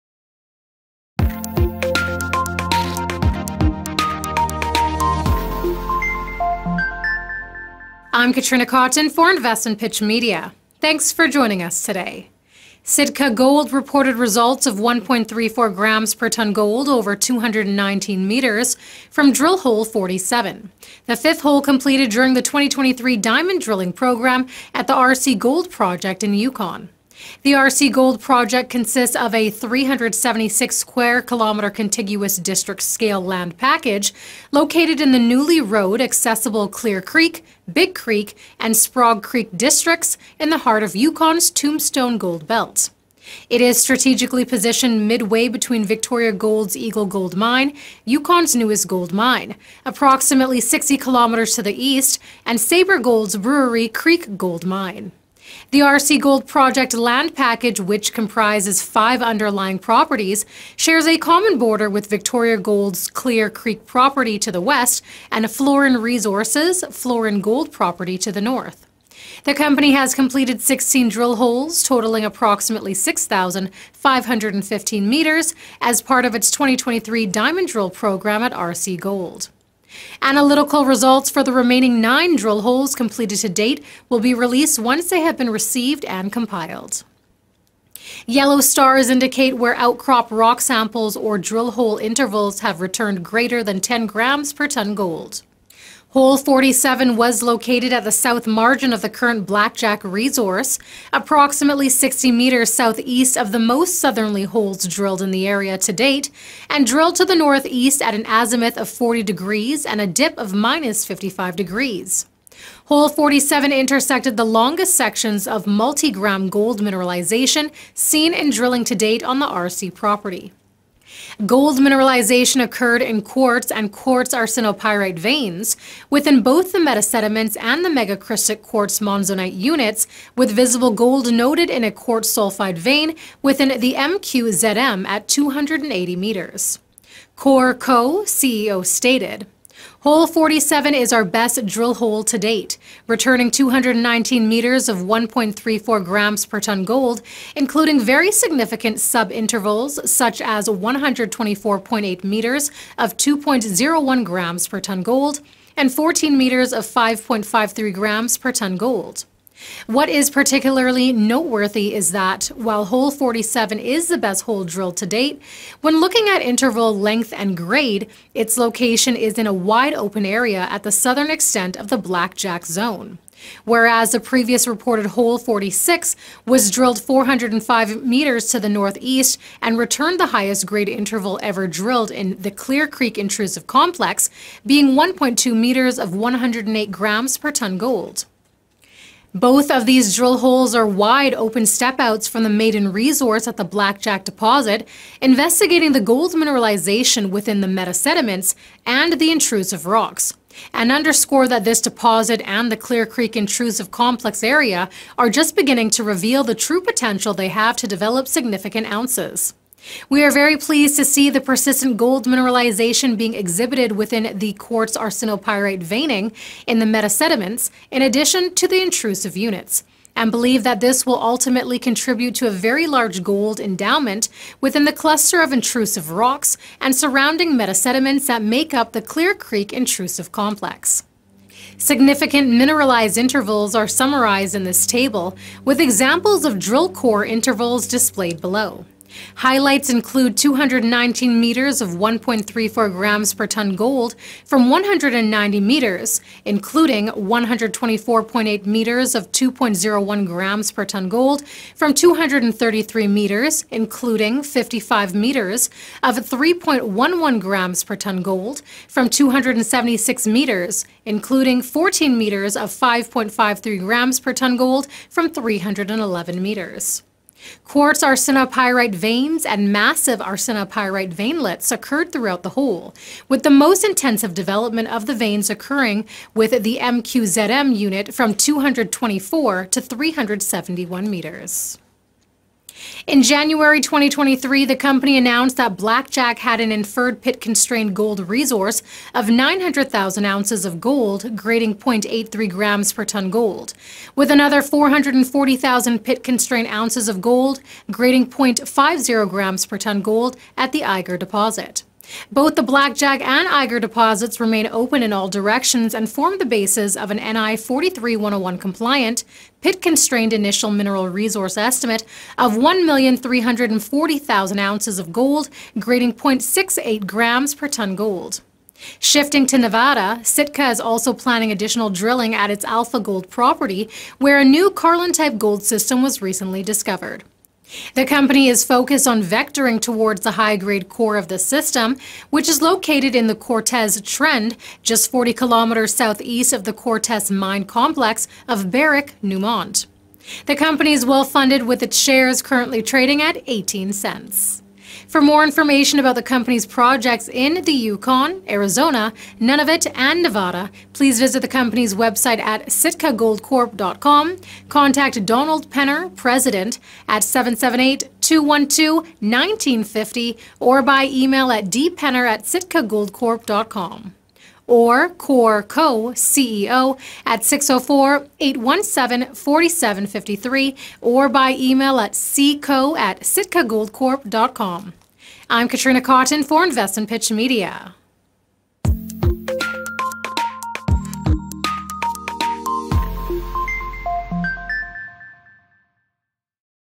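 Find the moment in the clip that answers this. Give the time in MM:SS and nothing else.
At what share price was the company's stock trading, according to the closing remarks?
05:43.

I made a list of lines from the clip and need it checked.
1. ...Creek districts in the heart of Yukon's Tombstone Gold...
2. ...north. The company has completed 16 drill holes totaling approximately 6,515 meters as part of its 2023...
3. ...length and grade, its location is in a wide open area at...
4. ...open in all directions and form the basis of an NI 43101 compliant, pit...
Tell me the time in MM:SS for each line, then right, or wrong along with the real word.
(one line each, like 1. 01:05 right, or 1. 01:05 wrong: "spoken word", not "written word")
1. 00:39 right
2. 01:08 right
3. 02:46 right
4. 05:04 right.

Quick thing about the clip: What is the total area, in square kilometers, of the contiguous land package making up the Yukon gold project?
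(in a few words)
376.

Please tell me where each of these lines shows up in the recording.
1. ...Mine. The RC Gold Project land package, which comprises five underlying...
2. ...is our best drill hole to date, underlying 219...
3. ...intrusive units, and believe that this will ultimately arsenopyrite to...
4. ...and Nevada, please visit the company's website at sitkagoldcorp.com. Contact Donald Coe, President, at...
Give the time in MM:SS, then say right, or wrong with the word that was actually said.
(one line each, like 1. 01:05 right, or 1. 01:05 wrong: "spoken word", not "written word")
1. 00:54 right
2. 02:20 wrong: "returning", not "underlying"
3. 03:38 wrong: "contribute", not "arsenopyrite"
4. 05:49 wrong: "Penner", not "Coe".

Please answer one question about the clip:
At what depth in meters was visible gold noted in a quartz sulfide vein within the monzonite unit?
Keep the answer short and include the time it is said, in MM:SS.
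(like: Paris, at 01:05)
280, at 02:15.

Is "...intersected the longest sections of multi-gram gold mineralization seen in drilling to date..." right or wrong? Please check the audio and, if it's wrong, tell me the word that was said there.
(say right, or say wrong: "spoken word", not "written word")
right.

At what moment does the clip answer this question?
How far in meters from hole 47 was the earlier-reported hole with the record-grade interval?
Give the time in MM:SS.
02:57.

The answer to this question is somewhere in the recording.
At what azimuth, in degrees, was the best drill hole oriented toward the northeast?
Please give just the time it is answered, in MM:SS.
01:48.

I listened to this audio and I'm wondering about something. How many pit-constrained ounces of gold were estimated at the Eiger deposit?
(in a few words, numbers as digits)
440,000.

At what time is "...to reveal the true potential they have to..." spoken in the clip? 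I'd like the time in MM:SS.
03:25.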